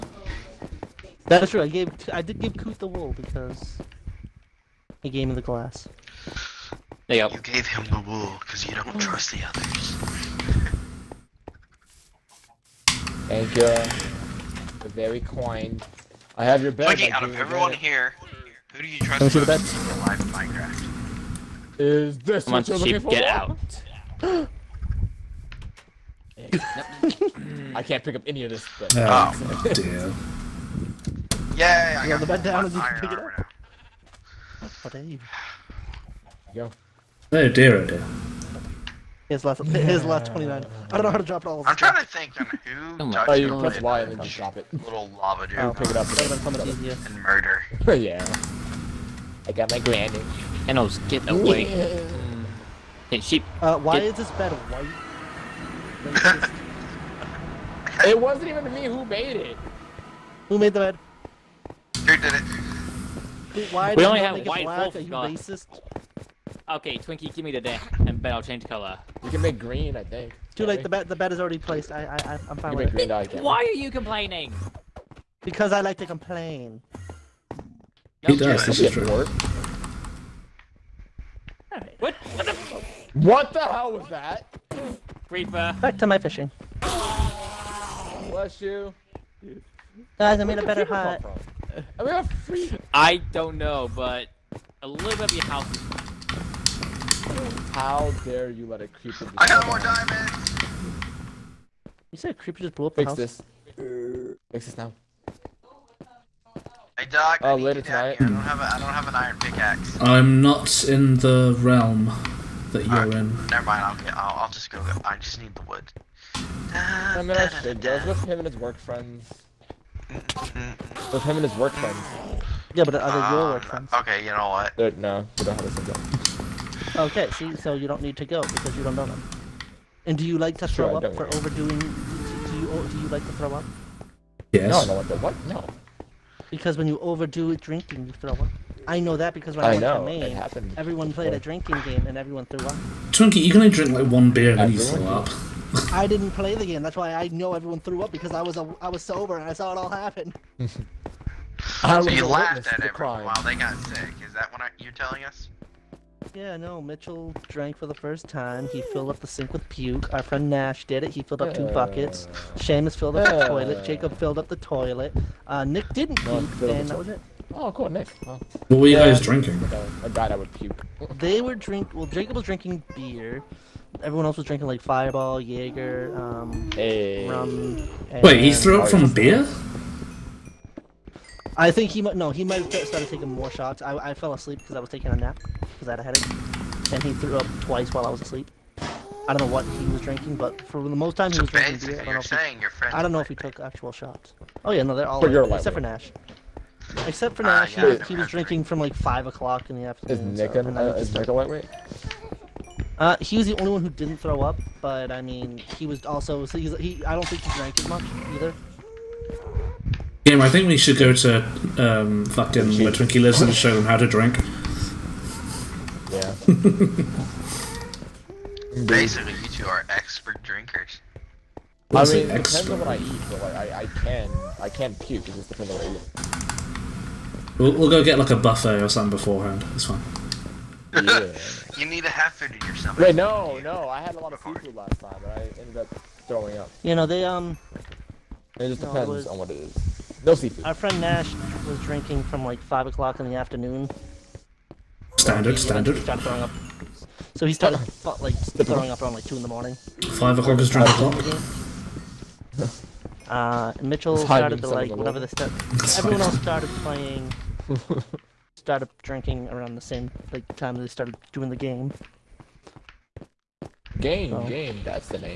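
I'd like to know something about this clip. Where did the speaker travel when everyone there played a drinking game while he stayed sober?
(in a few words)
Maine.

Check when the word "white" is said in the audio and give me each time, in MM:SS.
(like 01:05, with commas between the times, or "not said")
00:54, 01:04.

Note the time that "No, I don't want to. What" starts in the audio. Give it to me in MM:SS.
02:14.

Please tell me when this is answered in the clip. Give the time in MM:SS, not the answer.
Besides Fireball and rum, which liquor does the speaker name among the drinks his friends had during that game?
02:55.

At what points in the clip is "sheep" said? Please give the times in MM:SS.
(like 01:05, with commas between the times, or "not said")
00:23, 00:53.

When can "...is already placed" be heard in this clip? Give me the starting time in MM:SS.
01:11.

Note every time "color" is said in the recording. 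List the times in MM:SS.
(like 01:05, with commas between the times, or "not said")
01:08.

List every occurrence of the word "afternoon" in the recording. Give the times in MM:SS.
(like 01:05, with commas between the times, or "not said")
03:19, 04:03.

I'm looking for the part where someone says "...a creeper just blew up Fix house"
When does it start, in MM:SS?
01:42.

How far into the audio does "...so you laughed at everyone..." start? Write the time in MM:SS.
02:32.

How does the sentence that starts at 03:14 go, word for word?
Oh yeah, no, they're all but like, except for Nash.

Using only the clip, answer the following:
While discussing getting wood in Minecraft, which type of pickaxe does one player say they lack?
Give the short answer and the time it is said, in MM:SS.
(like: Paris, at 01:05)
Iron, at 01:49.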